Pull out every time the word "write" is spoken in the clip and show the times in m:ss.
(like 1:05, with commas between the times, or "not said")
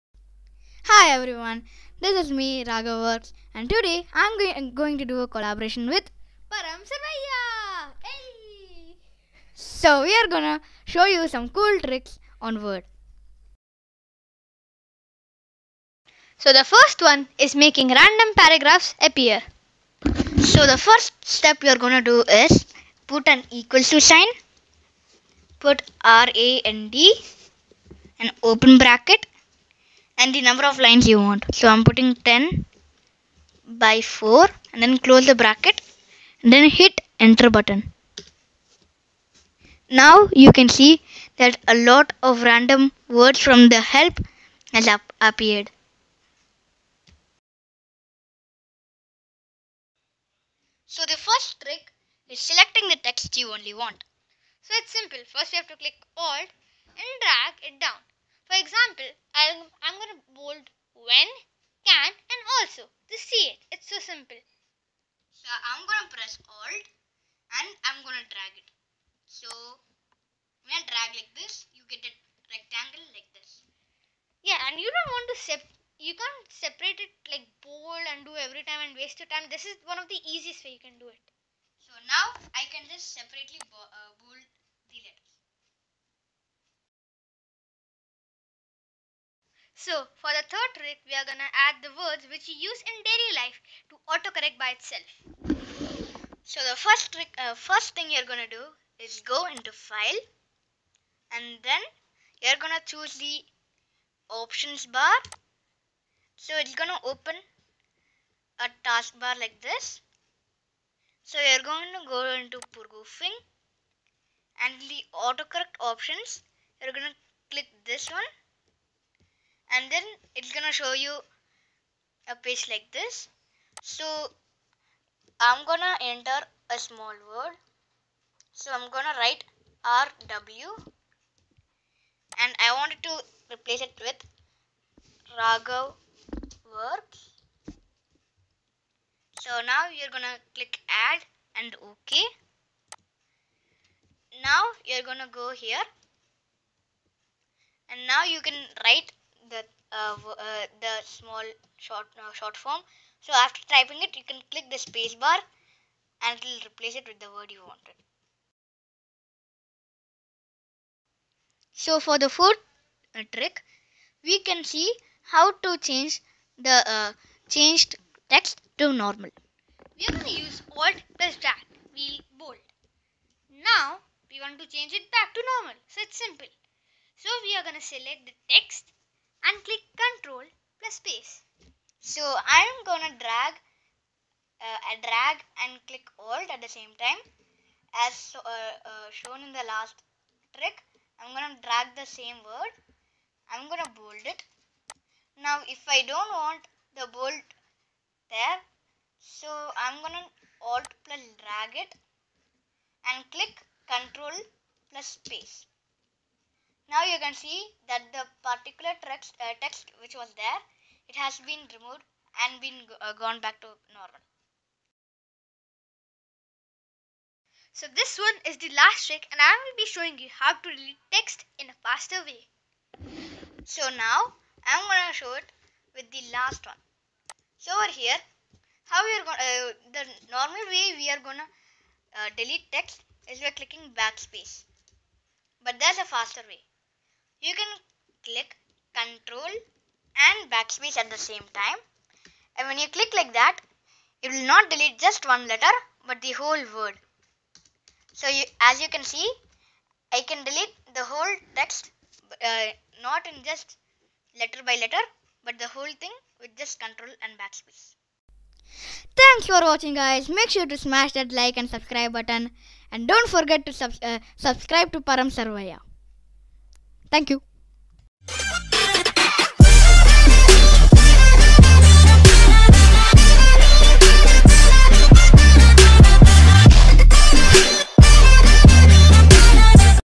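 2:09, 2:28.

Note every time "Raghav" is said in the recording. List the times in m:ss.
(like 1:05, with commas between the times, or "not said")
0:02, 2:15.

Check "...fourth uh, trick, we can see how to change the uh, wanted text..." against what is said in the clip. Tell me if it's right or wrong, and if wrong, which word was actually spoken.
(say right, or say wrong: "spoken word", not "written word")
wrong: "changed", not "wanted".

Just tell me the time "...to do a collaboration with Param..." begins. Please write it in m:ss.
0:04.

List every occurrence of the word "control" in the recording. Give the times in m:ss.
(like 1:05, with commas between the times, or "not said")
3:00, 3:23, 3:58, 4:16.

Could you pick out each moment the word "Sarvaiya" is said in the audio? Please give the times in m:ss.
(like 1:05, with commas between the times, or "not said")
0:06, 4:25.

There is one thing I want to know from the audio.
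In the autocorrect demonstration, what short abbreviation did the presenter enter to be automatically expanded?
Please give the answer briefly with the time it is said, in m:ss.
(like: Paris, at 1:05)
RW, at 2:09.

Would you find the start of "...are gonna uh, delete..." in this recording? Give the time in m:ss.
3:51.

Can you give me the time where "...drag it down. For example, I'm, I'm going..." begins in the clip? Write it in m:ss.
0:57.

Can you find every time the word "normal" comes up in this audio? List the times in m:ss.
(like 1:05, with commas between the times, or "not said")
2:49, 2:55, 3:33, 3:50.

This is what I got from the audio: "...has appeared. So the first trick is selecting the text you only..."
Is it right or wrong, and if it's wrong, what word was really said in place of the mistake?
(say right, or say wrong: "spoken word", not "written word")
right.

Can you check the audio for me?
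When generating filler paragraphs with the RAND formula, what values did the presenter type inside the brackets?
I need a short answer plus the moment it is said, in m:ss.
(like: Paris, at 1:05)
10 by 4, at 0:32.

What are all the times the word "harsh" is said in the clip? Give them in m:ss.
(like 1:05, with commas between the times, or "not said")
not said.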